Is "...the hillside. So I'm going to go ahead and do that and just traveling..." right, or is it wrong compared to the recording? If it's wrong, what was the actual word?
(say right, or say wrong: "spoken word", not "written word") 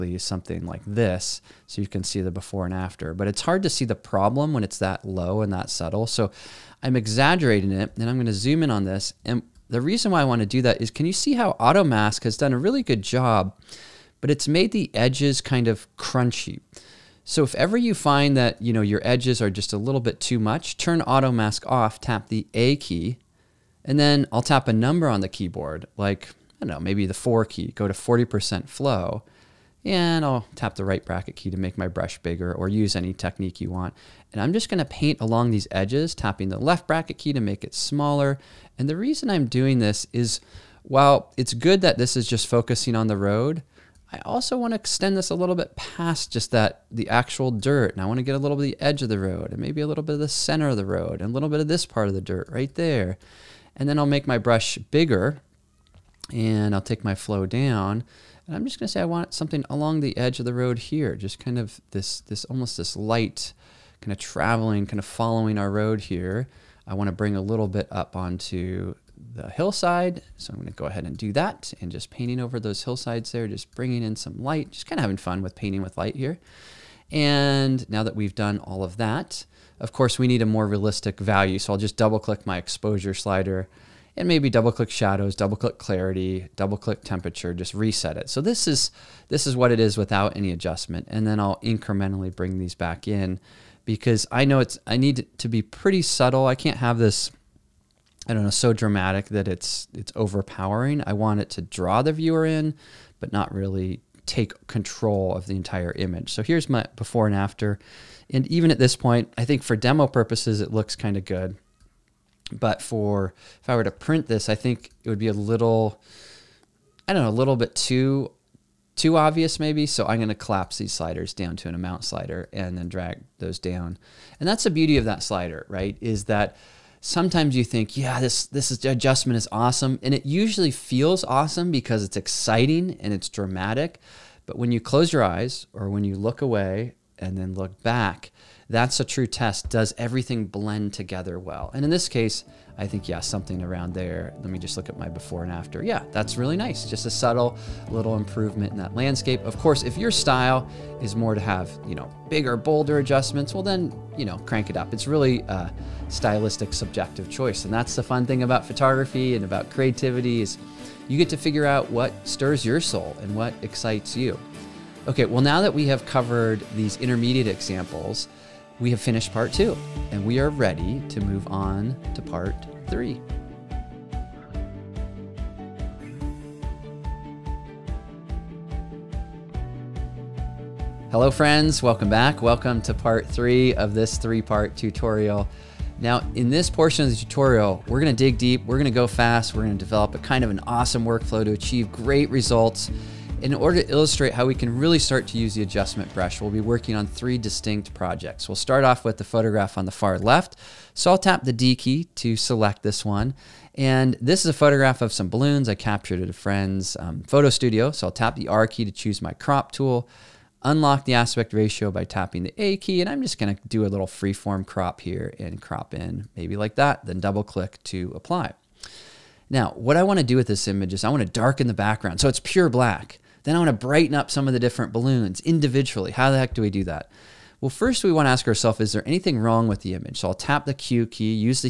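wrong: "painting", not "traveling".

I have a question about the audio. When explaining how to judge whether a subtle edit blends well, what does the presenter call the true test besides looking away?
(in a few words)
Close your eyes.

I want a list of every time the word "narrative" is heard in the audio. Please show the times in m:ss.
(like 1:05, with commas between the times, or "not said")
not said.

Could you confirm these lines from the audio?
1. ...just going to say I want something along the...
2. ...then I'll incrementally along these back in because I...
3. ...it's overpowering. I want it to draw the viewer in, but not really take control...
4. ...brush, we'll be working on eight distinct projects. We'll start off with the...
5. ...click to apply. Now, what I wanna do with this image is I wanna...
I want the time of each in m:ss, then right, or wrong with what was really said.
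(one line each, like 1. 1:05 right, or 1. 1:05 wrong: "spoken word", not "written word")
1. 0:58 right
2. 1:31 wrong: "bring", not "along"
3. 1:39 right
4. 3:16 wrong: "three", not "eight"
5. 3:37 right.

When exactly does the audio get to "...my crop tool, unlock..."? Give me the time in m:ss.
3:29.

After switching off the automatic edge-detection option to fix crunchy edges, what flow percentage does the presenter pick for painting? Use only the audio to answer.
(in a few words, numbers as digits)
40%.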